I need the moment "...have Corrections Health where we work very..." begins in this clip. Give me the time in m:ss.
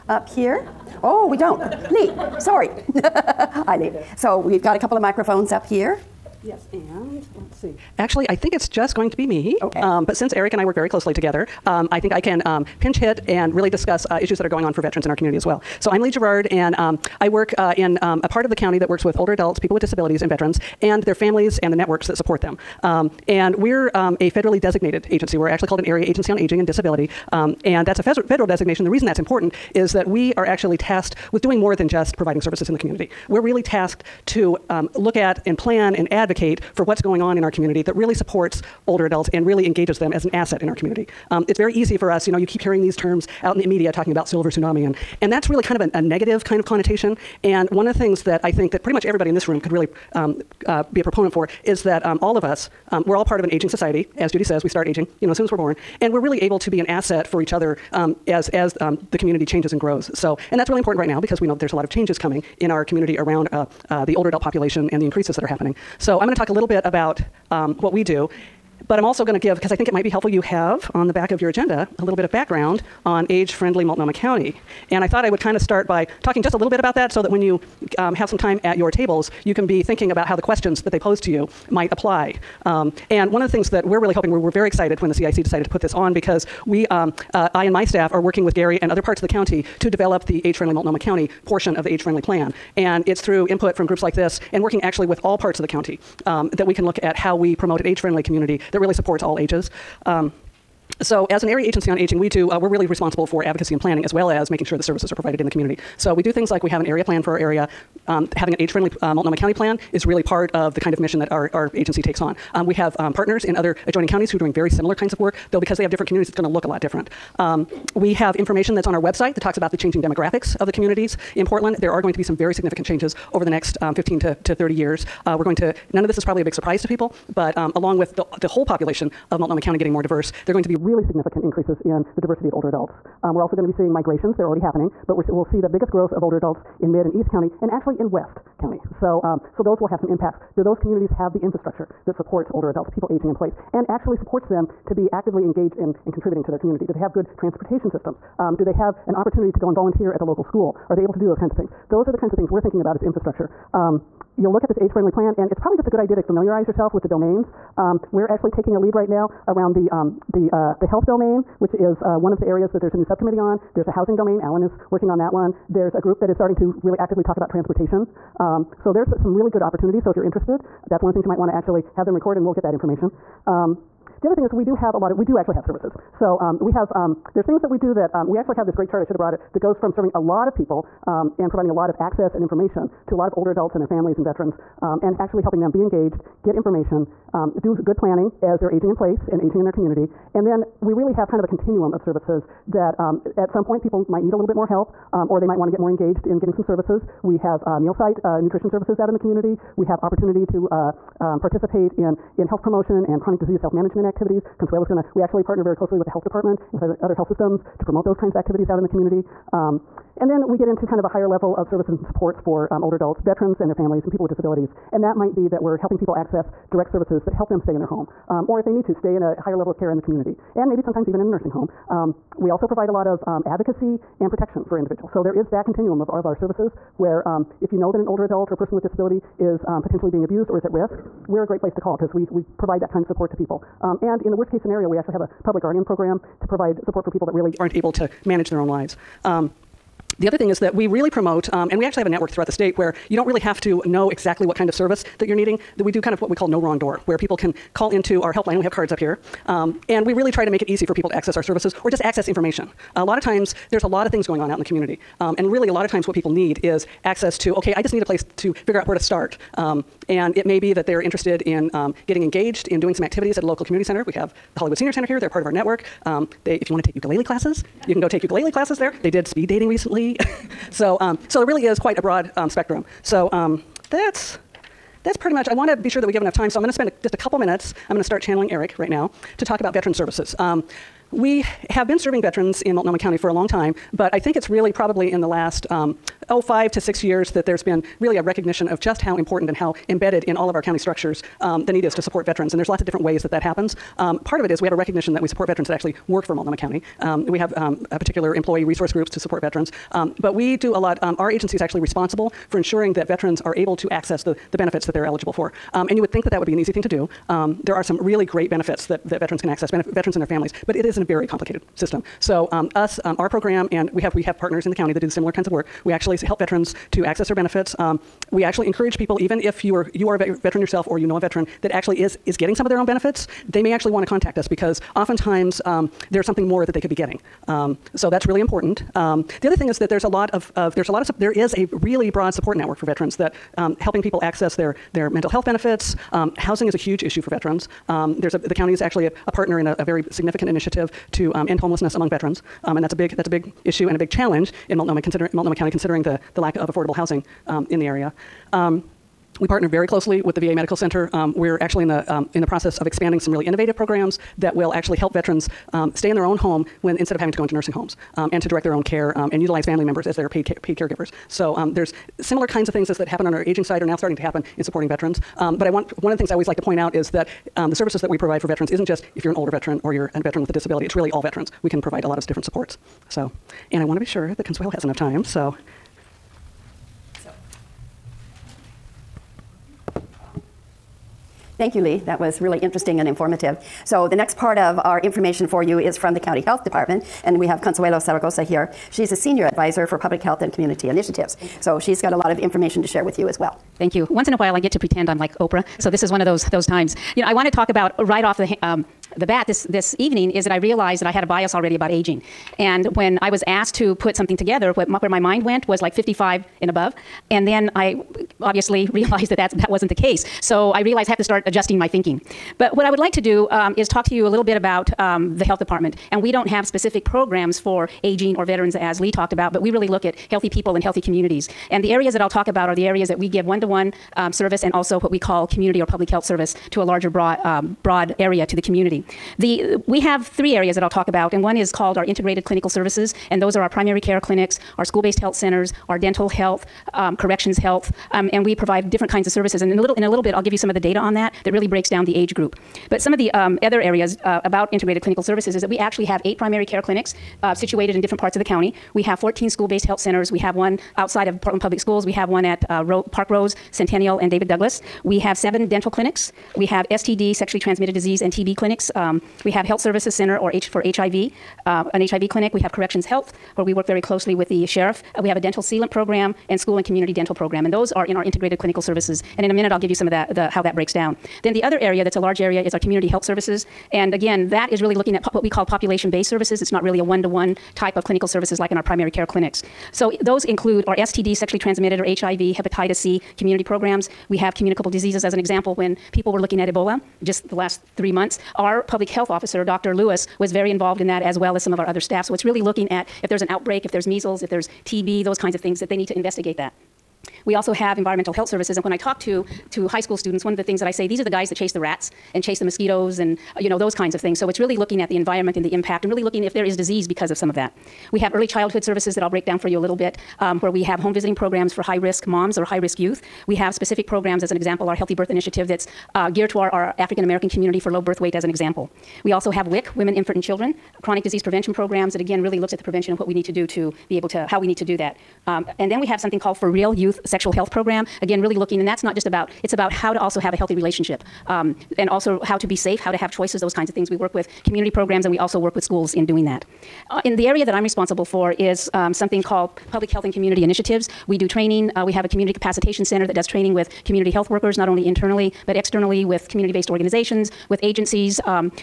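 7:42.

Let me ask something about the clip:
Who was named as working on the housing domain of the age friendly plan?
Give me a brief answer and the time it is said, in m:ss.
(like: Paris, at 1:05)
Alan, at 2:44.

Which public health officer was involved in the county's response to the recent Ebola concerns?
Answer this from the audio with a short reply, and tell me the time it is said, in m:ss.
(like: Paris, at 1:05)
Dr. Lewis, at 8:09.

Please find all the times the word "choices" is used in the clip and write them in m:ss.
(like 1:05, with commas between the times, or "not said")
8:53.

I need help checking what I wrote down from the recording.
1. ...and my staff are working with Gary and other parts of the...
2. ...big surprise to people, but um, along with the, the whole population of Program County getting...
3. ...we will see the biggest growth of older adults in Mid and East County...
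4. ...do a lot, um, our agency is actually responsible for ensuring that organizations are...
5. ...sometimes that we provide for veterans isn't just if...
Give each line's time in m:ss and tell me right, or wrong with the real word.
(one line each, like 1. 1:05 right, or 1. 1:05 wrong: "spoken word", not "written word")
1. 1:27 right
2. 2:06 wrong: "Multnomah", not "Program"
3. 2:15 right
4. 5:00 wrong: "veterans", not "organizations"
5. 6:07 wrong: "services", not "sometimes".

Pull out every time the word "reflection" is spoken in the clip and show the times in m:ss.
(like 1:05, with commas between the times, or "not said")
not said.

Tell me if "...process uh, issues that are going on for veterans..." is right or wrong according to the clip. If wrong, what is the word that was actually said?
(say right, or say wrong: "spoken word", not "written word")
wrong: "discuss", not "process".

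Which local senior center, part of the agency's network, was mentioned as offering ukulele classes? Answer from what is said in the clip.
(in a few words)
Hollywood Senior Center.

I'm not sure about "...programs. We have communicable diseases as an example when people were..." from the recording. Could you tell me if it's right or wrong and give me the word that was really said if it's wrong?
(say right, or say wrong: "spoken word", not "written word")
right.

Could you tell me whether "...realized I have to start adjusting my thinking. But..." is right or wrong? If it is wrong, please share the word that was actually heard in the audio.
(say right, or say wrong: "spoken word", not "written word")
right.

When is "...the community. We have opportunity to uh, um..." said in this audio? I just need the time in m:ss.
3:19.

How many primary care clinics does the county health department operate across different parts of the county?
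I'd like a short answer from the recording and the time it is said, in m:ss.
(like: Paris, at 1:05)
8, at 7:26.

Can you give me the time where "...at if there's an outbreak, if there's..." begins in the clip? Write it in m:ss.
8:12.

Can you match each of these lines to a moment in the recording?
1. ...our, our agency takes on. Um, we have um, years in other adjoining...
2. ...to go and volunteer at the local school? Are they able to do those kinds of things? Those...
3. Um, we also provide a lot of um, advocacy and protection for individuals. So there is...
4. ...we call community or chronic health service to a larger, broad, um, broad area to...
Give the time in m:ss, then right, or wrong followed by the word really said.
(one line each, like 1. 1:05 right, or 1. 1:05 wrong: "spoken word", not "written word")
1. 1:51 wrong: "partners", not "years"
2. 2:29 right
3. 3:41 right
4. 7:05 wrong: "public", not "chronic".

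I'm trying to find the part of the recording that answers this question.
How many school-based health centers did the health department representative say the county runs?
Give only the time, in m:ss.
7:29.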